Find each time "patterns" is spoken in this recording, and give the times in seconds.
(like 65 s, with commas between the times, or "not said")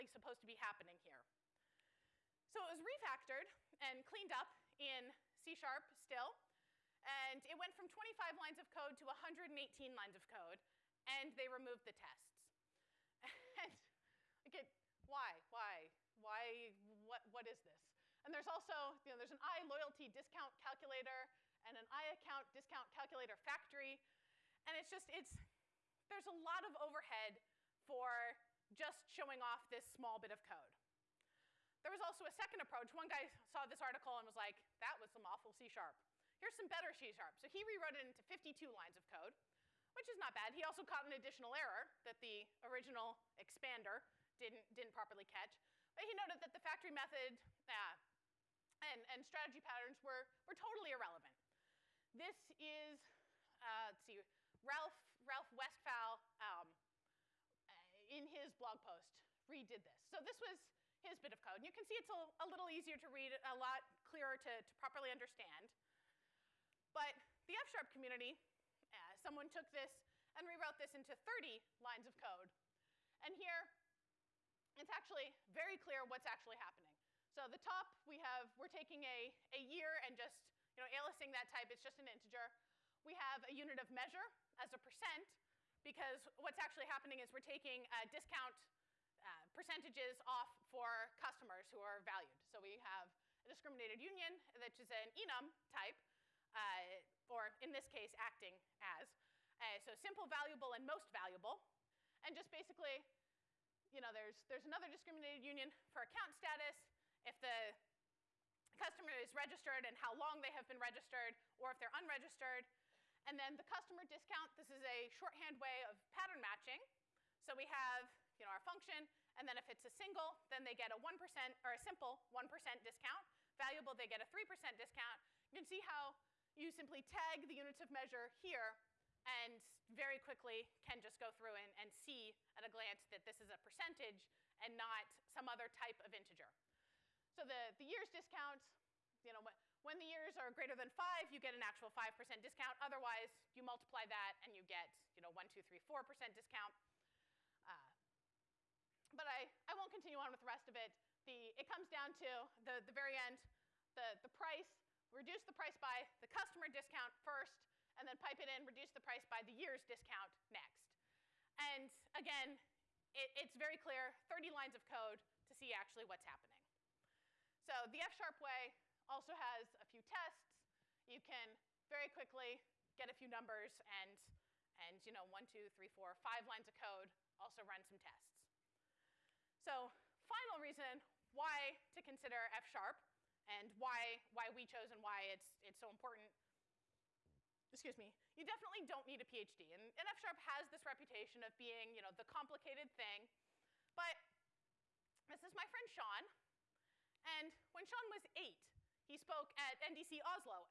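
49 s, 116 s.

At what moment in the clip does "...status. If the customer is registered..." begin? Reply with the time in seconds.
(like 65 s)
106 s.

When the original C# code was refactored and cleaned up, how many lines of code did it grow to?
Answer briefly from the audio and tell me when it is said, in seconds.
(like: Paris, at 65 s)
118, at 9 s.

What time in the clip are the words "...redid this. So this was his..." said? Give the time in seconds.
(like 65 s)
59 s.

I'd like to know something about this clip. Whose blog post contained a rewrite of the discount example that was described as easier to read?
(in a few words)
Ralf Westphal.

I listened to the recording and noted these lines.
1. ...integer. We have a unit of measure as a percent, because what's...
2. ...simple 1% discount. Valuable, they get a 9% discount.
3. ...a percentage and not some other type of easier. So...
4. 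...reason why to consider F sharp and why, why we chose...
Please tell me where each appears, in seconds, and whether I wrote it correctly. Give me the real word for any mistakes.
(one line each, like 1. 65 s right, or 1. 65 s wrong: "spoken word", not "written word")
1. 82 s right
2. 121 s wrong: "3", not "9"
3. 133 s wrong: "integer", not "easier"
4. 180 s right.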